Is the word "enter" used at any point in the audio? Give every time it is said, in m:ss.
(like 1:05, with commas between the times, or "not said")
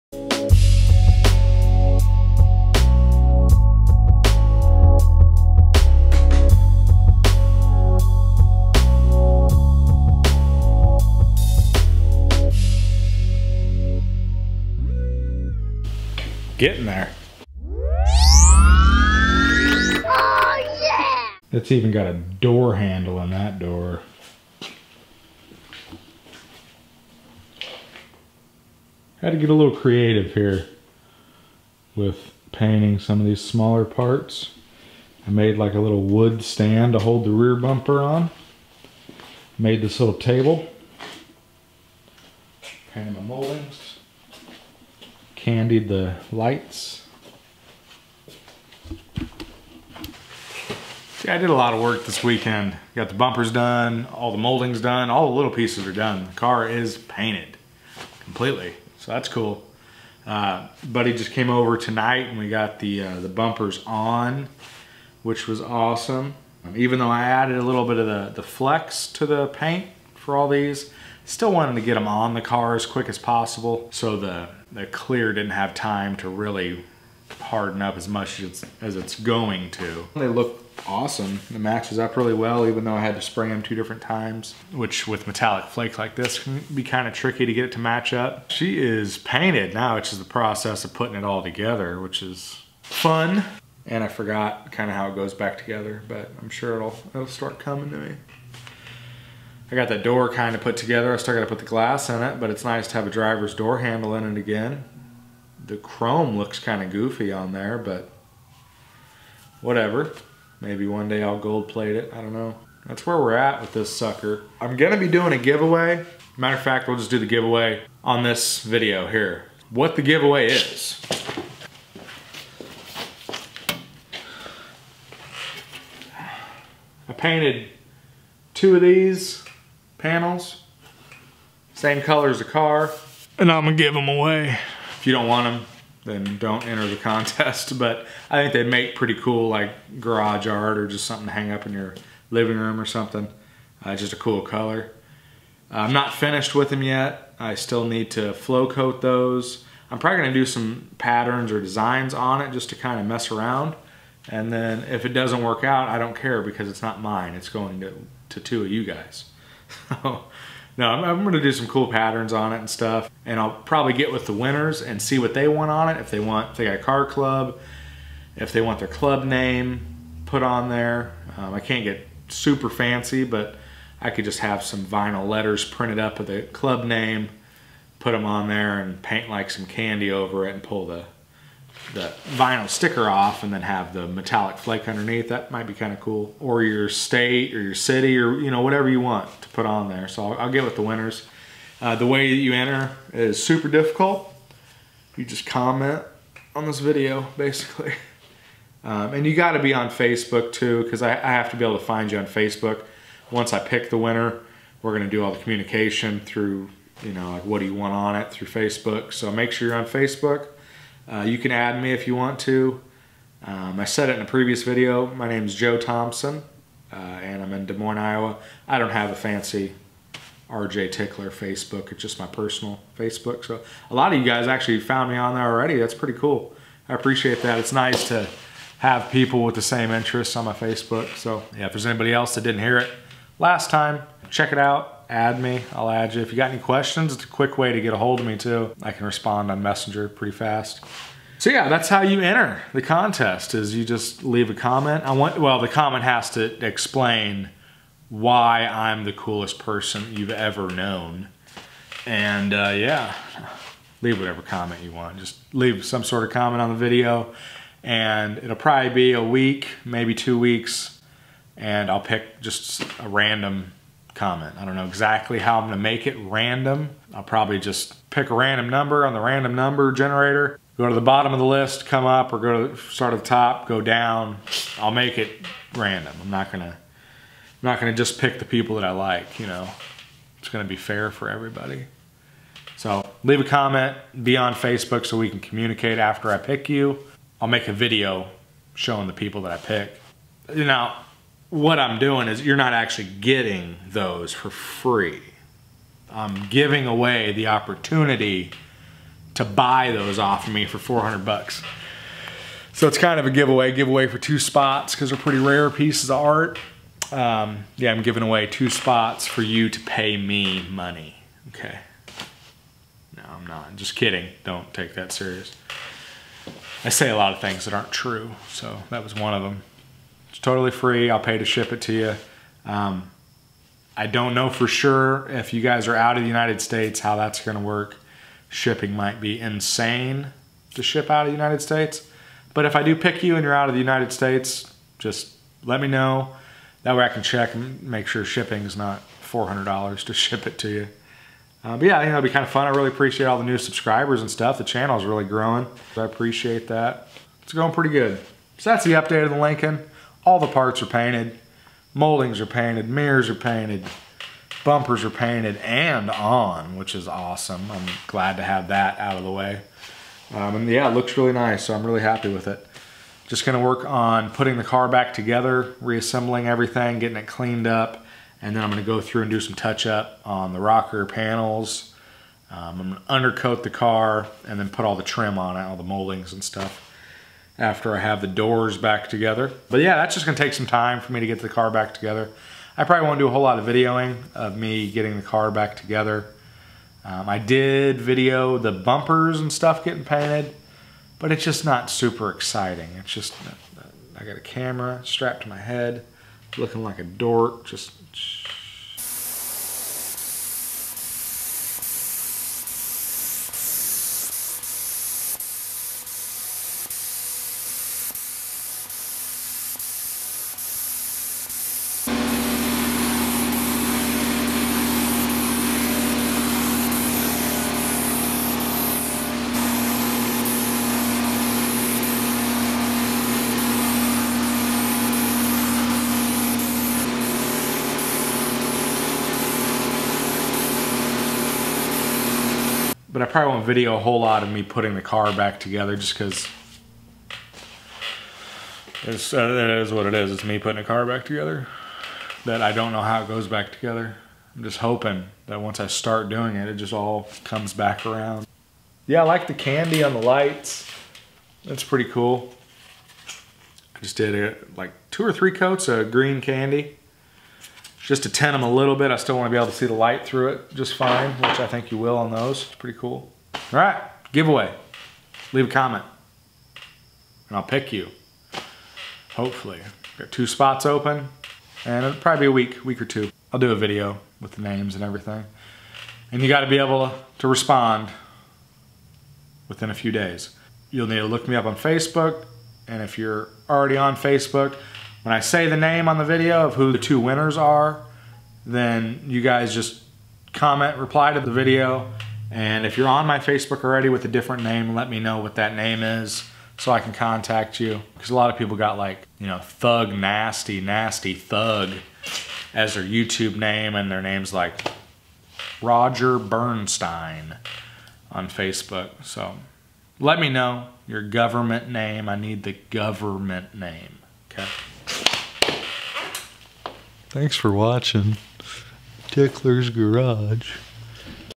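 2:16, 3:12, 4:02.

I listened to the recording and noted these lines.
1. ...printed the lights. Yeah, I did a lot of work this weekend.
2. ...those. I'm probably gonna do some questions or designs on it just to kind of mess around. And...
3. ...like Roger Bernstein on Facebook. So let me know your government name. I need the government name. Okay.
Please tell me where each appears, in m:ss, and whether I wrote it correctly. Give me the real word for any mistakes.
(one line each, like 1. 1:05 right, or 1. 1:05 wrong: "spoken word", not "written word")
1. 0:45 wrong: "candied", not "printed"
2. 2:29 wrong: "patterns", not "questions"
3. 8:24 right.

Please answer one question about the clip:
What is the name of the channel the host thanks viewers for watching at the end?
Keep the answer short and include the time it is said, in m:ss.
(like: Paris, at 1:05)
Tickler's Garage, at 8:39.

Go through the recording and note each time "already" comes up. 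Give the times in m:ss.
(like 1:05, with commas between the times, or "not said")
3:45, 8:03, 8:13.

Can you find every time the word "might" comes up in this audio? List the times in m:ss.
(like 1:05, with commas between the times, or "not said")
3:05, 5:28.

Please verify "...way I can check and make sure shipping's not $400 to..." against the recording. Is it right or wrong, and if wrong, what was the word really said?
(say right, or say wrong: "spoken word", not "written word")
right.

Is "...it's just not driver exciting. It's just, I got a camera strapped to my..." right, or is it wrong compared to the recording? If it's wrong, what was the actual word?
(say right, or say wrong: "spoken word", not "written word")
wrong: "super", not "driver".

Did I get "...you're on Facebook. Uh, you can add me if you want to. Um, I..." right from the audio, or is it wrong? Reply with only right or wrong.
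right.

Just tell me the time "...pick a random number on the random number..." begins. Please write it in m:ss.
4:28.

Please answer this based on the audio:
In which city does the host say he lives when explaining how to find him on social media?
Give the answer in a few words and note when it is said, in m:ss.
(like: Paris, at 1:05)
Des Moines, Iowa, at 3:37.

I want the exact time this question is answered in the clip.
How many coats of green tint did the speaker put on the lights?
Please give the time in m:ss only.
7:35.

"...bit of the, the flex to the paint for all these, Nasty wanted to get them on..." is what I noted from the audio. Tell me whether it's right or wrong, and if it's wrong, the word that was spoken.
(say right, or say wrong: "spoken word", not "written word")
wrong: "Still", not "Nasty".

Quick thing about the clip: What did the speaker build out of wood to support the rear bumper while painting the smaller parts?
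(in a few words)
a little wood stand.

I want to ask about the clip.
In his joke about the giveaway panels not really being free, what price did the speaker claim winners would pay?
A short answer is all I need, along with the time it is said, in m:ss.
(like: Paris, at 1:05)
$400, at 5:00.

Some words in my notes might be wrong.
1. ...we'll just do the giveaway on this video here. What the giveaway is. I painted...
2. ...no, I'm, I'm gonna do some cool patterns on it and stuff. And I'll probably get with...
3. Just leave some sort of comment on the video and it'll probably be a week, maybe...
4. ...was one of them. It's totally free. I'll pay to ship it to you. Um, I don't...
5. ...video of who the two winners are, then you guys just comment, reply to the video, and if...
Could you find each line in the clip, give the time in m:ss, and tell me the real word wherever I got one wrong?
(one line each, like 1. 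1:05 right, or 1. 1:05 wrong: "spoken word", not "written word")
1. 1:56 right
2. 2:40 right
3. 4:15 right
4. 5:19 right
5. 8:06 right.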